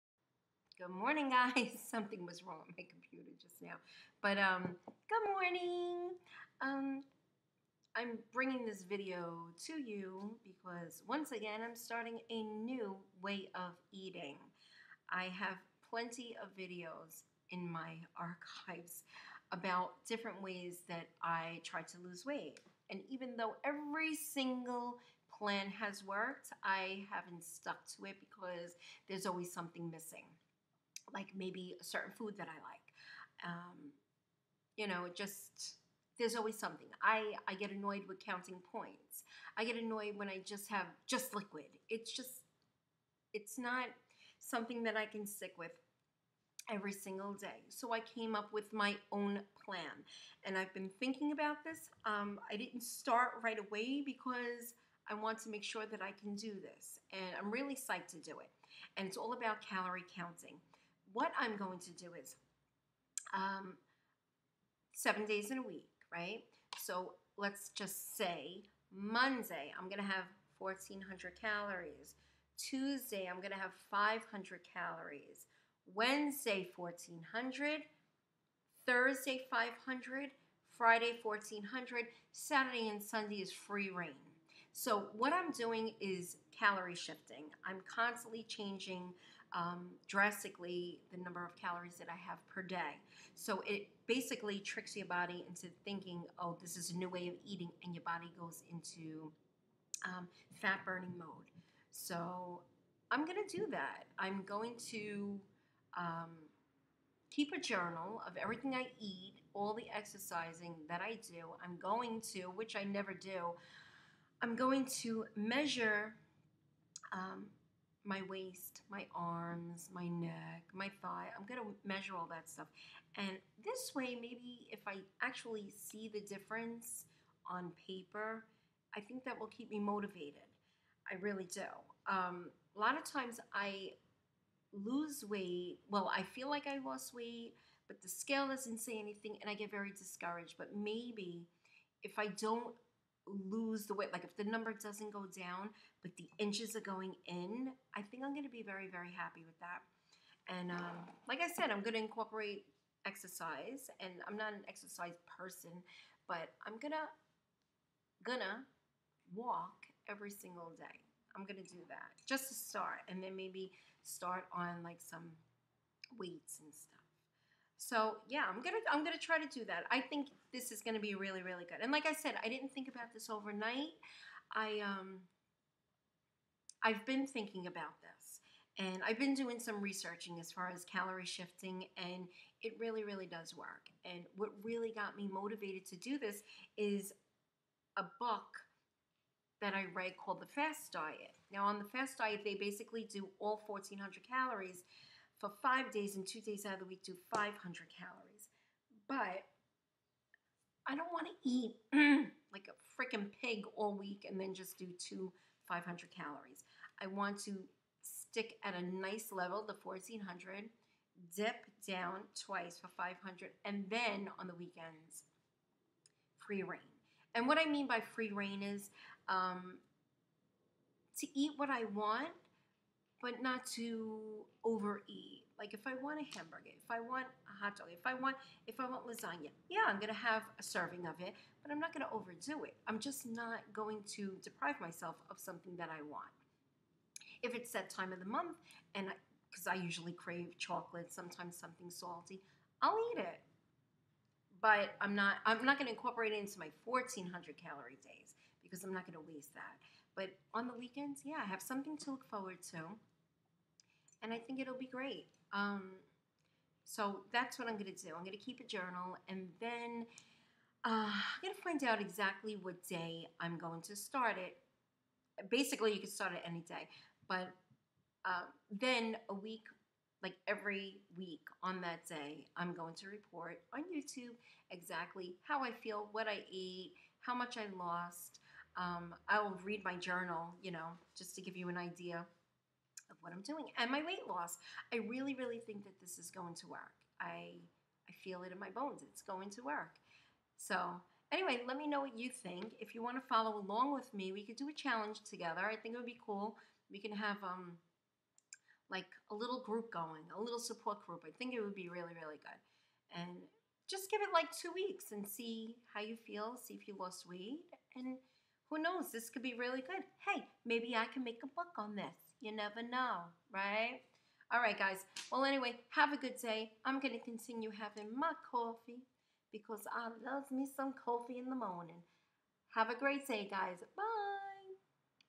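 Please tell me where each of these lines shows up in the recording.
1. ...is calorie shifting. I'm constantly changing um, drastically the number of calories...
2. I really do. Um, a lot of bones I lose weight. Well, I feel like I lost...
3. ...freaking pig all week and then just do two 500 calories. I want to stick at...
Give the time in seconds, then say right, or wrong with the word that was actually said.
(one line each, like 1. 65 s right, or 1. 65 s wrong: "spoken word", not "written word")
1. 85 s right
2. 131 s wrong: "times", not "bones"
3. 203 s right.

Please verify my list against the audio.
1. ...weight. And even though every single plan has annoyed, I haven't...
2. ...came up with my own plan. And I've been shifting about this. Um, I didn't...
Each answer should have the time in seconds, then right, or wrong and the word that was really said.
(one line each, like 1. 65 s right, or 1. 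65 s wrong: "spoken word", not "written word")
1. 22 s wrong: "worked", not "annoyed"
2. 48 s wrong: "thinking", not "shifting".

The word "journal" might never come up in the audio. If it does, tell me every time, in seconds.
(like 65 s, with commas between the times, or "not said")
107 s, 258 s, 279 s.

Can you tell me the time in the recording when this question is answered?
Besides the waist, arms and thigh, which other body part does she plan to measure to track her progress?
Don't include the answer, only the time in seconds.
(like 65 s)
120 s.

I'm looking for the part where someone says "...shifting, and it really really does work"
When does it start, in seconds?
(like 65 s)
181 s.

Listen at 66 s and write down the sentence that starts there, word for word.
So let's just say Monday, I'm going to have 1,400 calories.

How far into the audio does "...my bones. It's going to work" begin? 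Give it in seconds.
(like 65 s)
288 s.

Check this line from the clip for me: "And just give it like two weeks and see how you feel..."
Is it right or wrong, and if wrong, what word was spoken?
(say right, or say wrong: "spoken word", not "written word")
right.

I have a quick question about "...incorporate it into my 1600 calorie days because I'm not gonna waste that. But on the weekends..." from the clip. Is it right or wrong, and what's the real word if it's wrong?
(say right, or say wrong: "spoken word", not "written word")
wrong: "1400", not "1600".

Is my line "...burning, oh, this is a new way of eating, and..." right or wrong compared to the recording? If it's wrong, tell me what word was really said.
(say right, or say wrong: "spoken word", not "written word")
wrong: "thinking", not "burning".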